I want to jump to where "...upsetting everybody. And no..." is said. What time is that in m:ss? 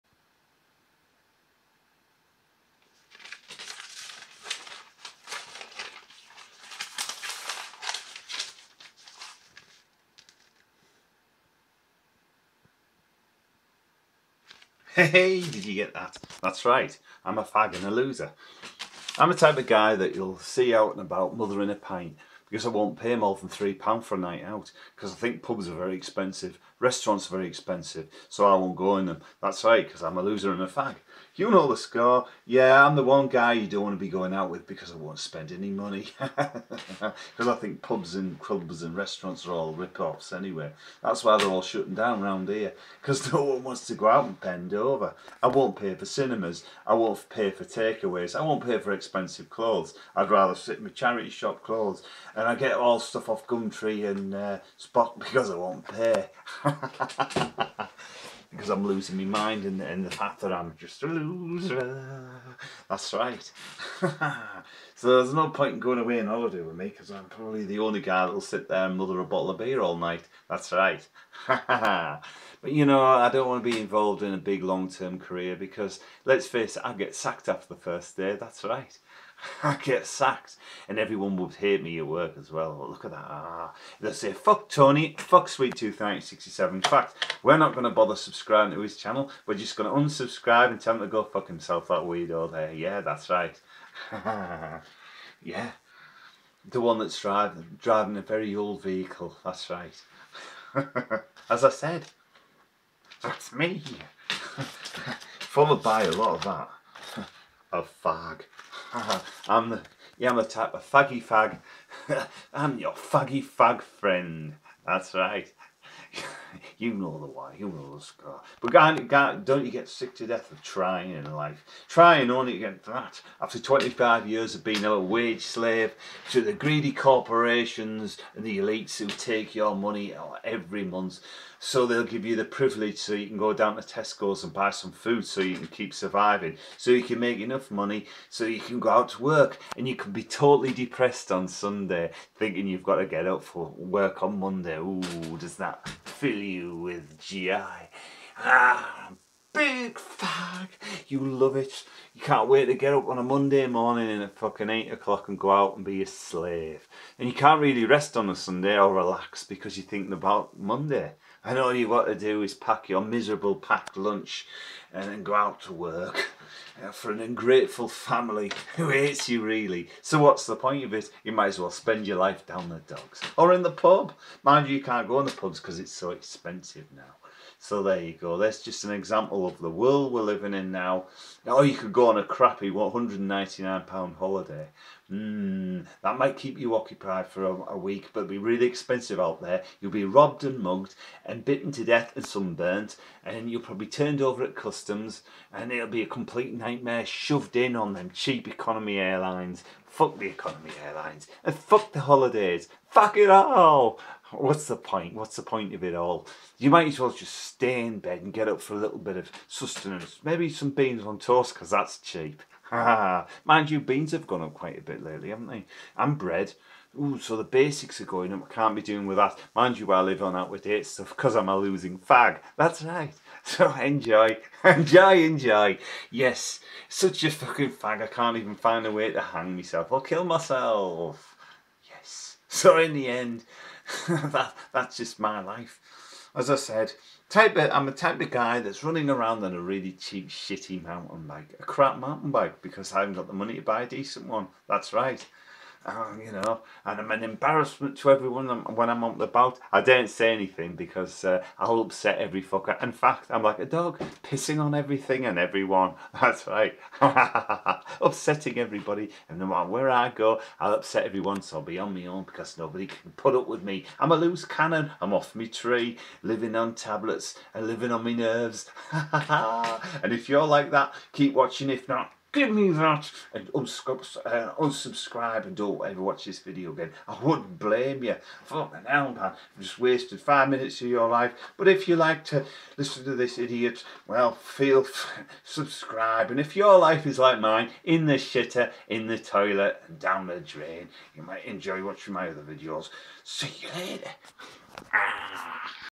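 4:17.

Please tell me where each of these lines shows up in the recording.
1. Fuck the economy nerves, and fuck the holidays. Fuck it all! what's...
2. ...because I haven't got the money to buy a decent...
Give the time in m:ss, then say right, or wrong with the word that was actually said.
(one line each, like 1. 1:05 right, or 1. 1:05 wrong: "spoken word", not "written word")
1. 3:19 wrong: "airlines", not "nerves"
2. 4:02 right.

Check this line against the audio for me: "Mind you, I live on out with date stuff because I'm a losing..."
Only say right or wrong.
right.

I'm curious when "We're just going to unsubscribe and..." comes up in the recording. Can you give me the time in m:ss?
1:29.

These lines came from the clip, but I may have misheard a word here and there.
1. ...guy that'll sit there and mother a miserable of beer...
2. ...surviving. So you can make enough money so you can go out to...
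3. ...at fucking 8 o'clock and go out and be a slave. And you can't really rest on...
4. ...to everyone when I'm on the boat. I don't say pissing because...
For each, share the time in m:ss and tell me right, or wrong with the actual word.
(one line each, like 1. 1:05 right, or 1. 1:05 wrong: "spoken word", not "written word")
1. 1:08 wrong: "bottle", not "miserable"
2. 2:15 right
3. 2:34 right
4. 4:07 wrong: "anything", not "pissing".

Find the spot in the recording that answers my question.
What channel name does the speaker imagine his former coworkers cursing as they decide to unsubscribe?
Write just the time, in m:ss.
1:25.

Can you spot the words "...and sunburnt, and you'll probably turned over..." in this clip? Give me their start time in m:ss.
3:12.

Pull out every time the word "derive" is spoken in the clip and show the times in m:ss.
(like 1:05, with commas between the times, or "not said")
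not said.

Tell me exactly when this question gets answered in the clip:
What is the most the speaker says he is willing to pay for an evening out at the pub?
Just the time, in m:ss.
0:23.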